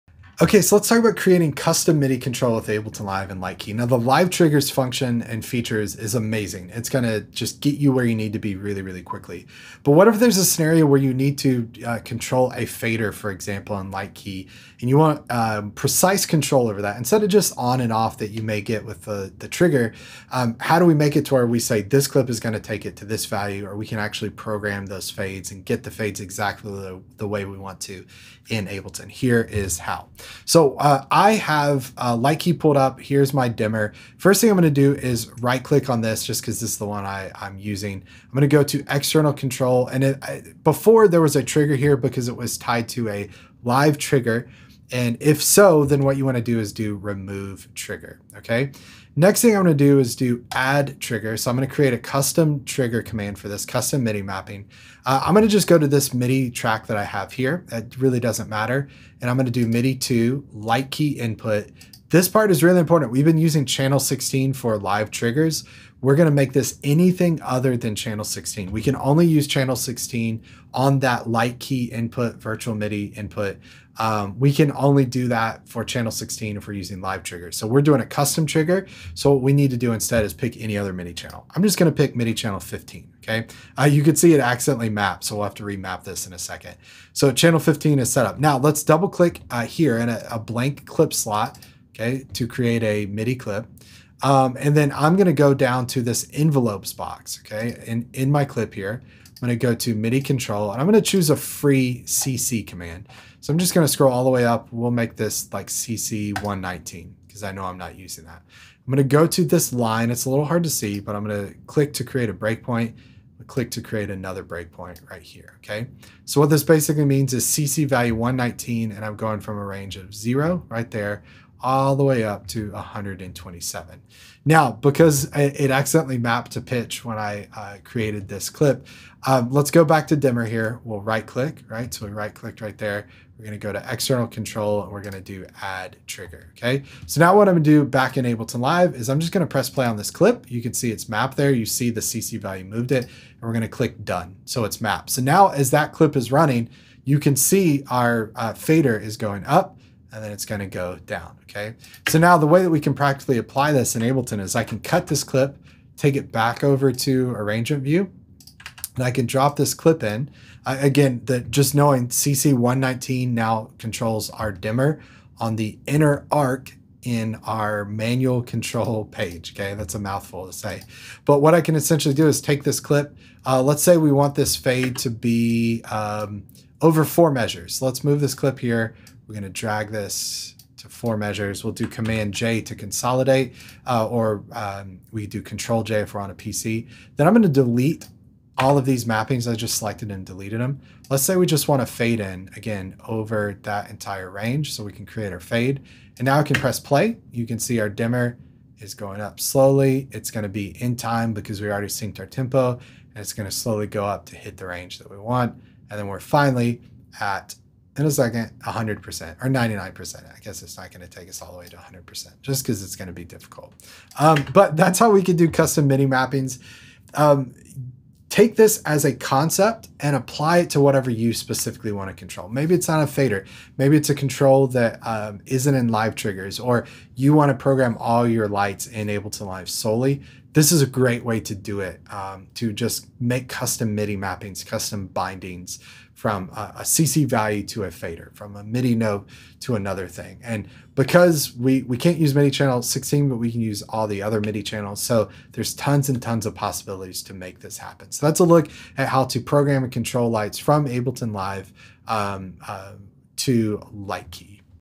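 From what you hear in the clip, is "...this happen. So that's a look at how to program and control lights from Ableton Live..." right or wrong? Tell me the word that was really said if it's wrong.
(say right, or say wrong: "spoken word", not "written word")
right.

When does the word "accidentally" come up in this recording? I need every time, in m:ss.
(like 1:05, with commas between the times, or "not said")
1:24, 2:05.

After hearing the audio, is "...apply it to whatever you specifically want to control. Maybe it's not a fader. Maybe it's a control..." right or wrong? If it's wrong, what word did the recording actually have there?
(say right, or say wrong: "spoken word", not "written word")
right.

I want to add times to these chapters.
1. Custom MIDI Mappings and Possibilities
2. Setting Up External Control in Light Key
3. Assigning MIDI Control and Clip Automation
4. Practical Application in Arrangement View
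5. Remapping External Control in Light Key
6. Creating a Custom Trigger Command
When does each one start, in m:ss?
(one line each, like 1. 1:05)
1. 3:34
2. 0:20
3. 1:43
4. 2:41
5. 2:09
6. 1:14.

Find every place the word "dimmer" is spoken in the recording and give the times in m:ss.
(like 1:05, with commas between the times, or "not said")
0:33, 2:10, 2:44, 3:17.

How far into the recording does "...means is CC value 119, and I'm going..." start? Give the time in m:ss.
1:57.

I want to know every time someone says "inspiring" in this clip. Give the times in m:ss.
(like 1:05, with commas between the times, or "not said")
not said.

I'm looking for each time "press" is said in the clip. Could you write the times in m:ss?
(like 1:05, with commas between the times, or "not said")
2:19, 3:16.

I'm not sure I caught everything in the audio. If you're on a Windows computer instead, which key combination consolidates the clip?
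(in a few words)
Control J.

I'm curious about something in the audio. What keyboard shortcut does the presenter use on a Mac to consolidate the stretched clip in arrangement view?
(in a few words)
Command J.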